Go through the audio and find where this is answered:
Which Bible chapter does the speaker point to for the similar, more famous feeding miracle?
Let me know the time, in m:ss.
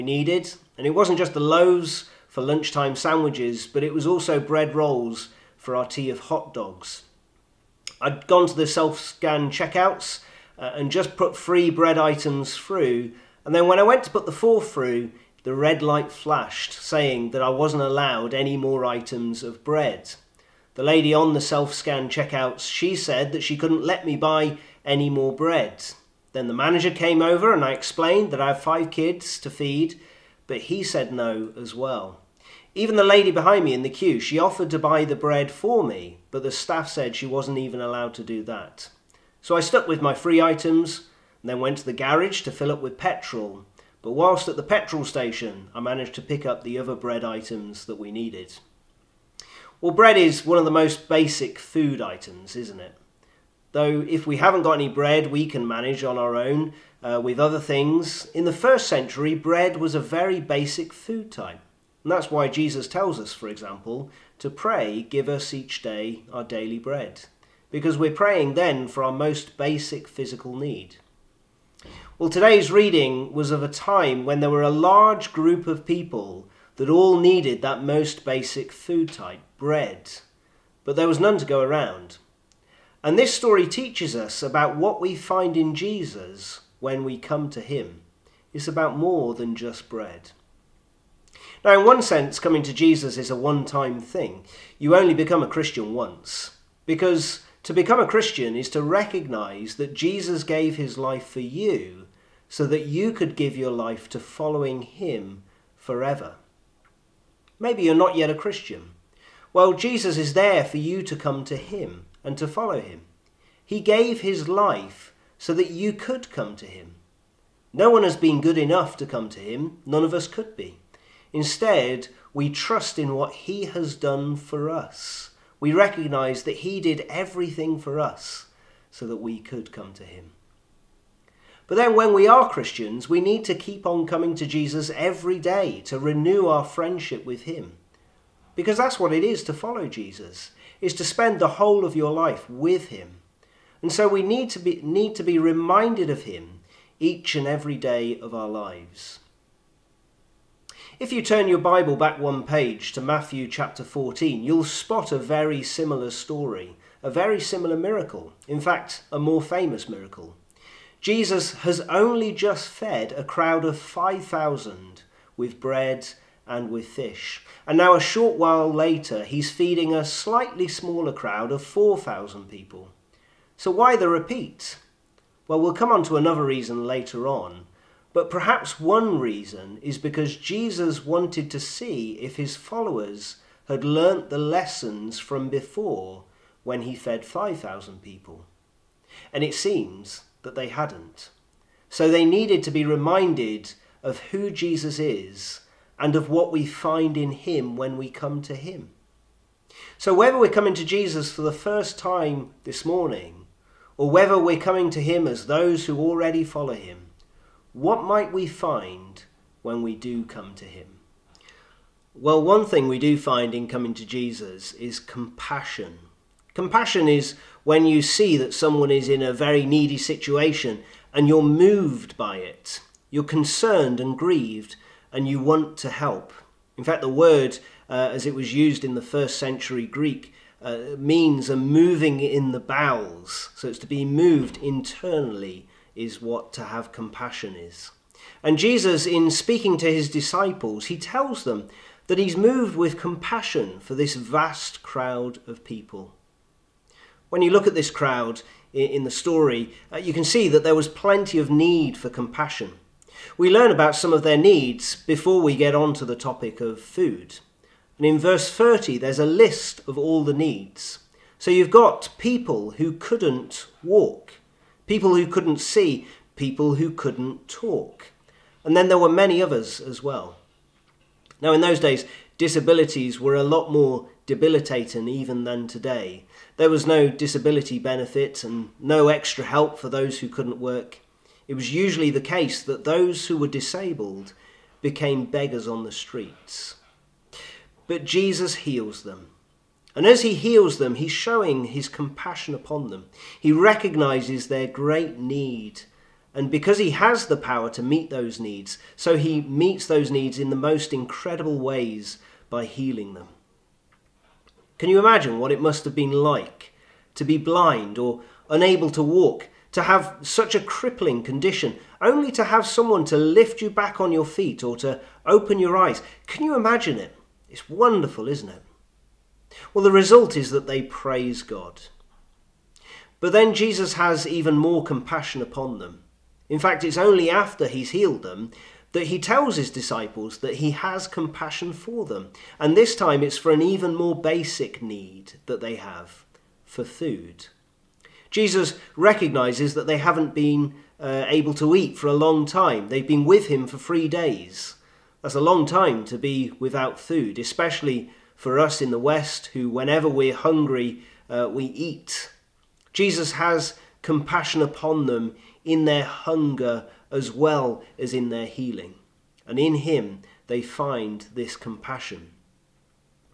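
2:33.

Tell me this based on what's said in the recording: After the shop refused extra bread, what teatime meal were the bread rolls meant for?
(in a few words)
Hot dogs.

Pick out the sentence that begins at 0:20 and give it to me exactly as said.
The lady on the self-scan checkouts, she said that she couldn't let me buy any more bread.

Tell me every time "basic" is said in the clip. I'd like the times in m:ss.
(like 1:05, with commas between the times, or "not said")
0:51, 1:00, 1:09, 1:18, 5:34.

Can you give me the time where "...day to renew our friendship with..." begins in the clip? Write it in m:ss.
2:15.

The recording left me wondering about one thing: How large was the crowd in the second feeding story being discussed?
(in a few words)
4,000.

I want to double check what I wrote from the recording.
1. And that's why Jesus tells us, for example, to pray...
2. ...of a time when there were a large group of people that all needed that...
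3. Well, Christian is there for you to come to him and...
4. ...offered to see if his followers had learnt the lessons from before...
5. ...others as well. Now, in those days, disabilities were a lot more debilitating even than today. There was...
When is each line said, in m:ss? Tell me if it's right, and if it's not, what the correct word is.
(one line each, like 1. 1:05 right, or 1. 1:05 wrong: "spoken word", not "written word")
1. 1:02 right
2. 1:13 right
3. 1:49 wrong: "Jesus", not "Christian"
4. 3:01 wrong: "wanted", not "offered"
5. 4:29 right.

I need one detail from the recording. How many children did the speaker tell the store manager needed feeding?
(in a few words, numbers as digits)
5.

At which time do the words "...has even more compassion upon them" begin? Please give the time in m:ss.
5:23.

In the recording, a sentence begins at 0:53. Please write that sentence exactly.
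Though if we haven't got any bread, we can manage on our own uh, with other things.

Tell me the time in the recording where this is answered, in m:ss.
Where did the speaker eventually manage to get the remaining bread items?
0:44.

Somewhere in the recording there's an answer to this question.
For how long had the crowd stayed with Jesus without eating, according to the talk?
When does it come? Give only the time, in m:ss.
5:43.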